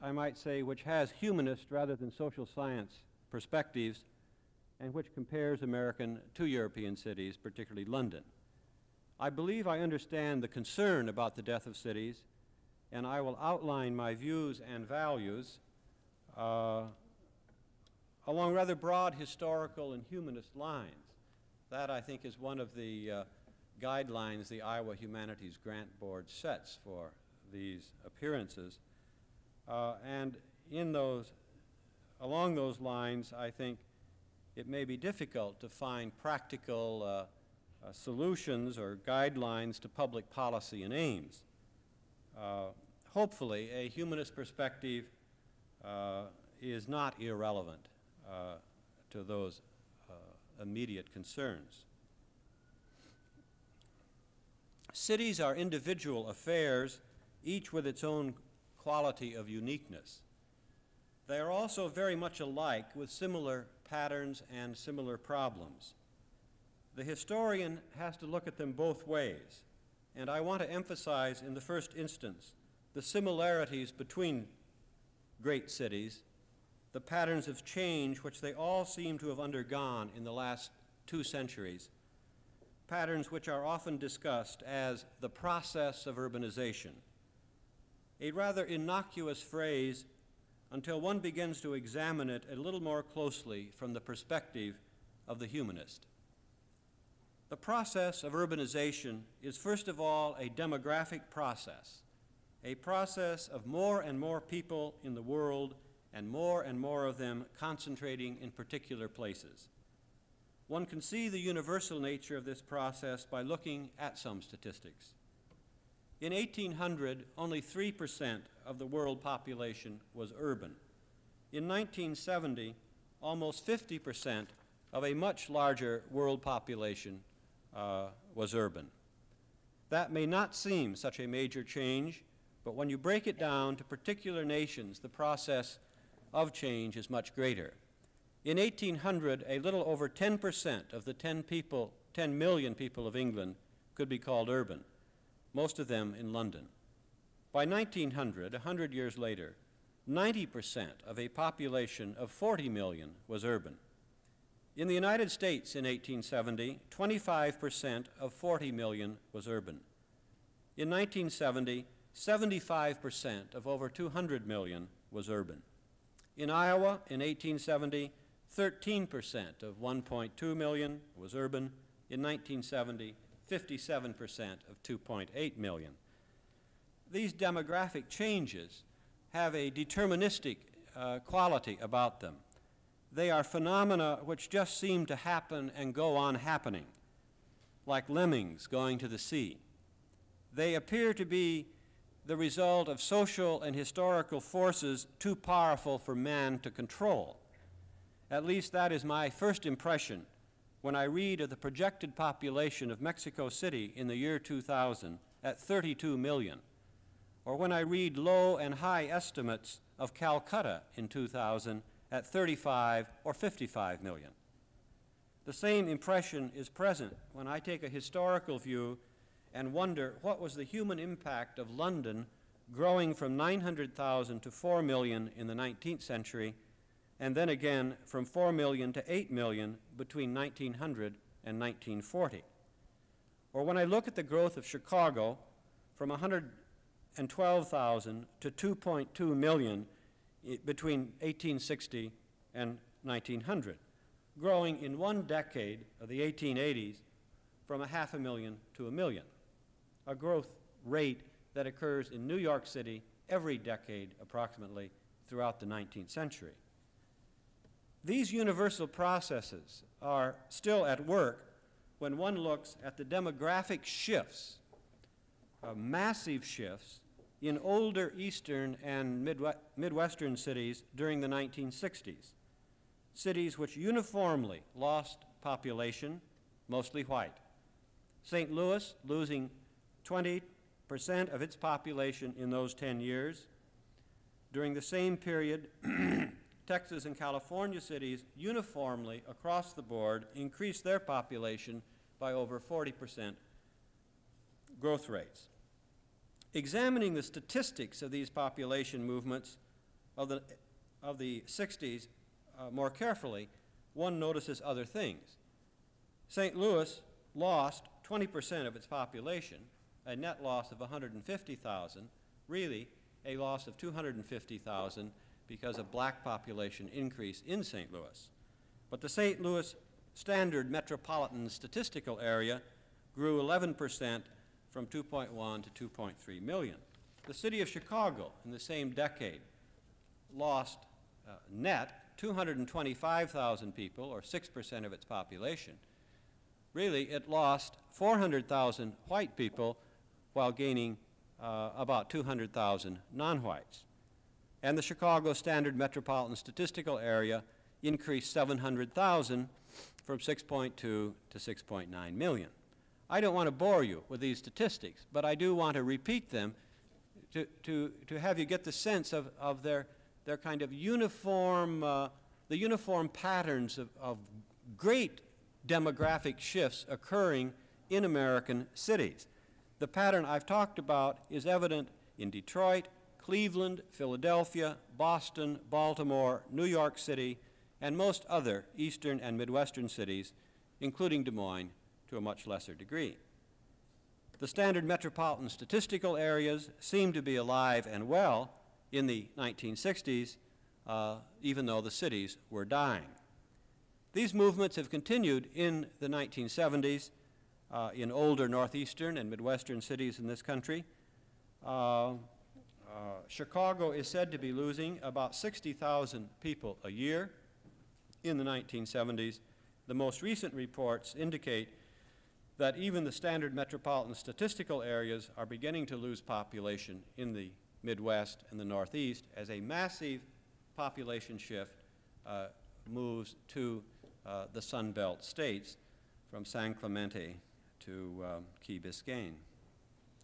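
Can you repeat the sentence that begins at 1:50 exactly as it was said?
One can see the universal nature of this process by looking at some statistics.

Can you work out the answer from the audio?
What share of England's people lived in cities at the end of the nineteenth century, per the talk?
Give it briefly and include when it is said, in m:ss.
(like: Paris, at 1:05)
90%, at 2:30.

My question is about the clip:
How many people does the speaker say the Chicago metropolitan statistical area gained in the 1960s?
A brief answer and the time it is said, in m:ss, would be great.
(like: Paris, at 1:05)
700,000, at 5:48.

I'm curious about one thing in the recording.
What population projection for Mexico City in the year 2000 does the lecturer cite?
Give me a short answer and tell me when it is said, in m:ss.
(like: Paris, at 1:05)
32 million, at 3:25.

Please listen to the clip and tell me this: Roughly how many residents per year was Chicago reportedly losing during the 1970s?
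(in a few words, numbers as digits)
about 60,000.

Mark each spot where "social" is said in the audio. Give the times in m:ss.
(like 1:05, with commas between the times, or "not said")
0:02, 3:13.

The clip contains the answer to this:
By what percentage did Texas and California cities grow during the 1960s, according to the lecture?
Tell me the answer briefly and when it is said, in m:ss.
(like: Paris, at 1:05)
over 40%, at 4:52.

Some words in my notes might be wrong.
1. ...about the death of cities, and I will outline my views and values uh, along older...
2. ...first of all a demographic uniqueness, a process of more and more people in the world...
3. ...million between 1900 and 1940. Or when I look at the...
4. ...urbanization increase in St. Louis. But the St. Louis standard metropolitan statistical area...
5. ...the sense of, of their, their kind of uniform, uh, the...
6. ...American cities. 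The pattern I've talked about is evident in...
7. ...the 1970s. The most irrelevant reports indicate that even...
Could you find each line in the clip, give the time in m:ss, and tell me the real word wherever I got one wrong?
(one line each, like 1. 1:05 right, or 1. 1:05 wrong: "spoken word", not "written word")
1. 0:11 wrong: "rather", not "older"
2. 1:39 wrong: "process", not "uniqueness"
3. 3:49 right
4. 5:16 wrong: "population", not "urbanization"
5. 5:58 right
6. 6:08 right
7. 6:48 wrong: "recent", not "irrelevant".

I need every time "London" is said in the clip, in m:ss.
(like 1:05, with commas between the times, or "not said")
0:07, 2:26, 3:41.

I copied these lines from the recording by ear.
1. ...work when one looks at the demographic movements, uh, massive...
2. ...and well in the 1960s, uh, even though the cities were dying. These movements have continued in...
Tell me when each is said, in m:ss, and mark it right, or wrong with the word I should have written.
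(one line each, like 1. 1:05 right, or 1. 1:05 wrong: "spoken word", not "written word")
1. 4:21 wrong: "shifts", not "movements"
2. 6:27 right.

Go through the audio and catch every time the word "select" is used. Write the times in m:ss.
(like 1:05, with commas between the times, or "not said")
not said.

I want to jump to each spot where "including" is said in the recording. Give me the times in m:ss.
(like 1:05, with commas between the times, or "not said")
6:20.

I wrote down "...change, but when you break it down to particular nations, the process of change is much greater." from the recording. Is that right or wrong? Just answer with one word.
right.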